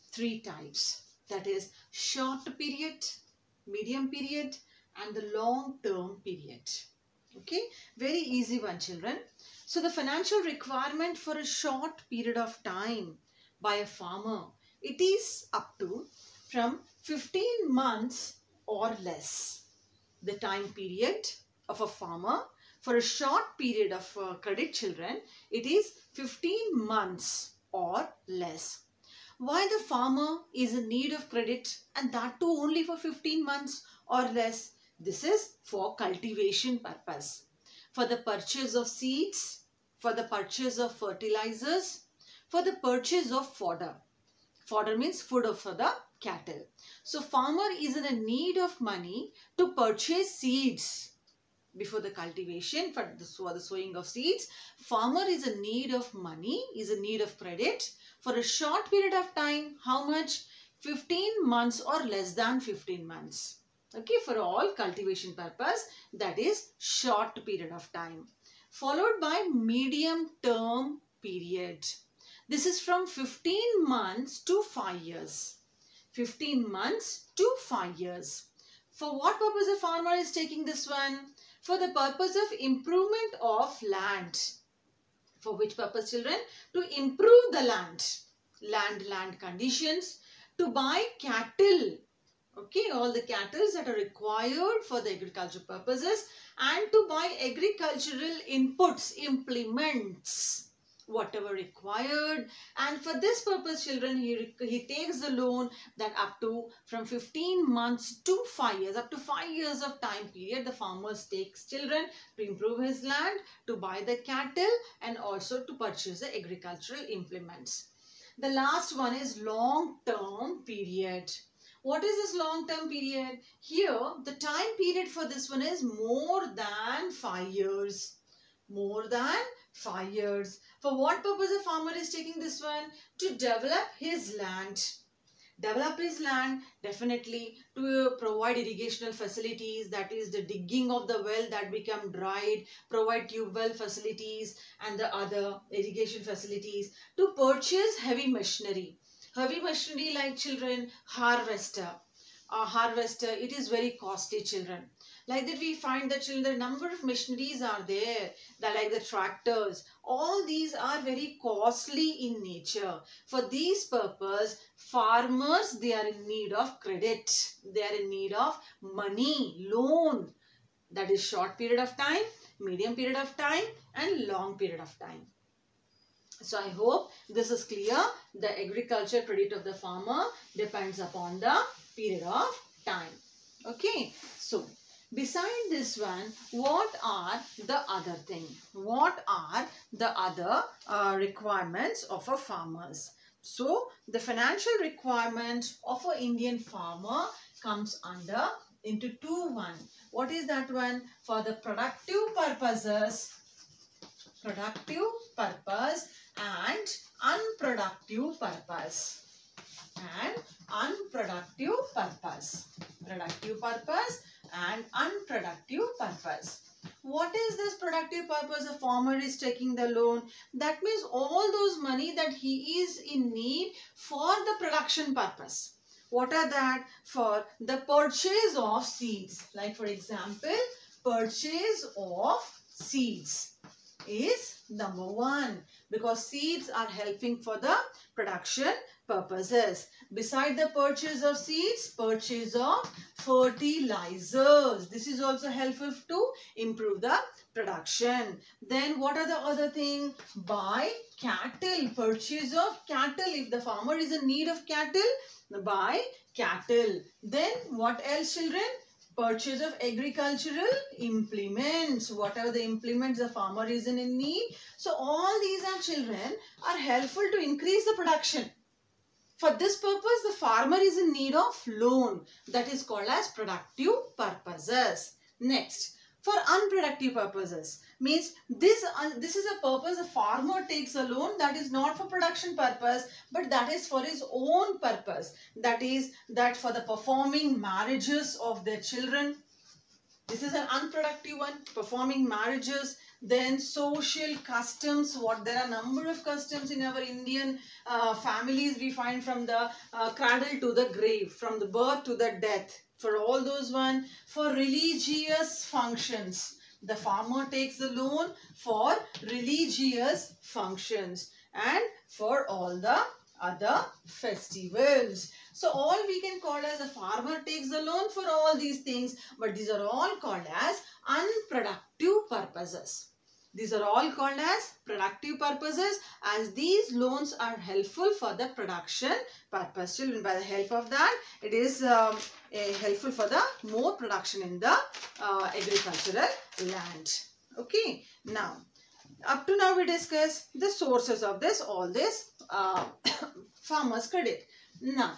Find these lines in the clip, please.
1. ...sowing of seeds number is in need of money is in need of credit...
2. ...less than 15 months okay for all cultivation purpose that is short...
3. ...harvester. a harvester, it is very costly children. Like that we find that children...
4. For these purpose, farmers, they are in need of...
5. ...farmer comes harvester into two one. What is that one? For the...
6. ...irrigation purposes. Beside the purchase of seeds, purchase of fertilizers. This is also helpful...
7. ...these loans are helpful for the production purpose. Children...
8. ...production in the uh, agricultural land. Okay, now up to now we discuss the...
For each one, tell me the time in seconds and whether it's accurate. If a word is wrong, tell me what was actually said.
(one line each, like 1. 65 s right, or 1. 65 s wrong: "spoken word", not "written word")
1. 53 s wrong: "farmer", not "number"
2. 62 s right
3. 151 s right
4. 163 s right
5. 196 s wrong: "under", not "harvester"
6. 238 s wrong: "production", not "irrigation"
7. 326 s right
8. 333 s right.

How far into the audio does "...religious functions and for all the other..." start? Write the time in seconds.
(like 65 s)
309 s.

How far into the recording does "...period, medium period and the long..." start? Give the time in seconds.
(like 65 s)
2 s.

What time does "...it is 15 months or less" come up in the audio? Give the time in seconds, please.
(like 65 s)
25 s.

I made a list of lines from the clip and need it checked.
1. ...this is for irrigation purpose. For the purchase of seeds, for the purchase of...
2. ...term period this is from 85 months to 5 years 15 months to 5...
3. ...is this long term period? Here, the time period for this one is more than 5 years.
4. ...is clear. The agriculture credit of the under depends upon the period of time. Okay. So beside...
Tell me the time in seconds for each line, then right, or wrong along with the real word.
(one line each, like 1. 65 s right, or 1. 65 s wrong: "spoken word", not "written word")
1. 34 s wrong: "cultivation", not "irrigation"
2. 70 s wrong: "15", not "85"
3. 122 s right
4. 177 s wrong: "farmer", not "under".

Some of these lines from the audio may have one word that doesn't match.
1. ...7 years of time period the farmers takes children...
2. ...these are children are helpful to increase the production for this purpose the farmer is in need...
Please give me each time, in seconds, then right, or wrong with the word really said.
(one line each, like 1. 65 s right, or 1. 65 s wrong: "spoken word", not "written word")
1. 109 s wrong: "5", not "7"
2. 265 s right.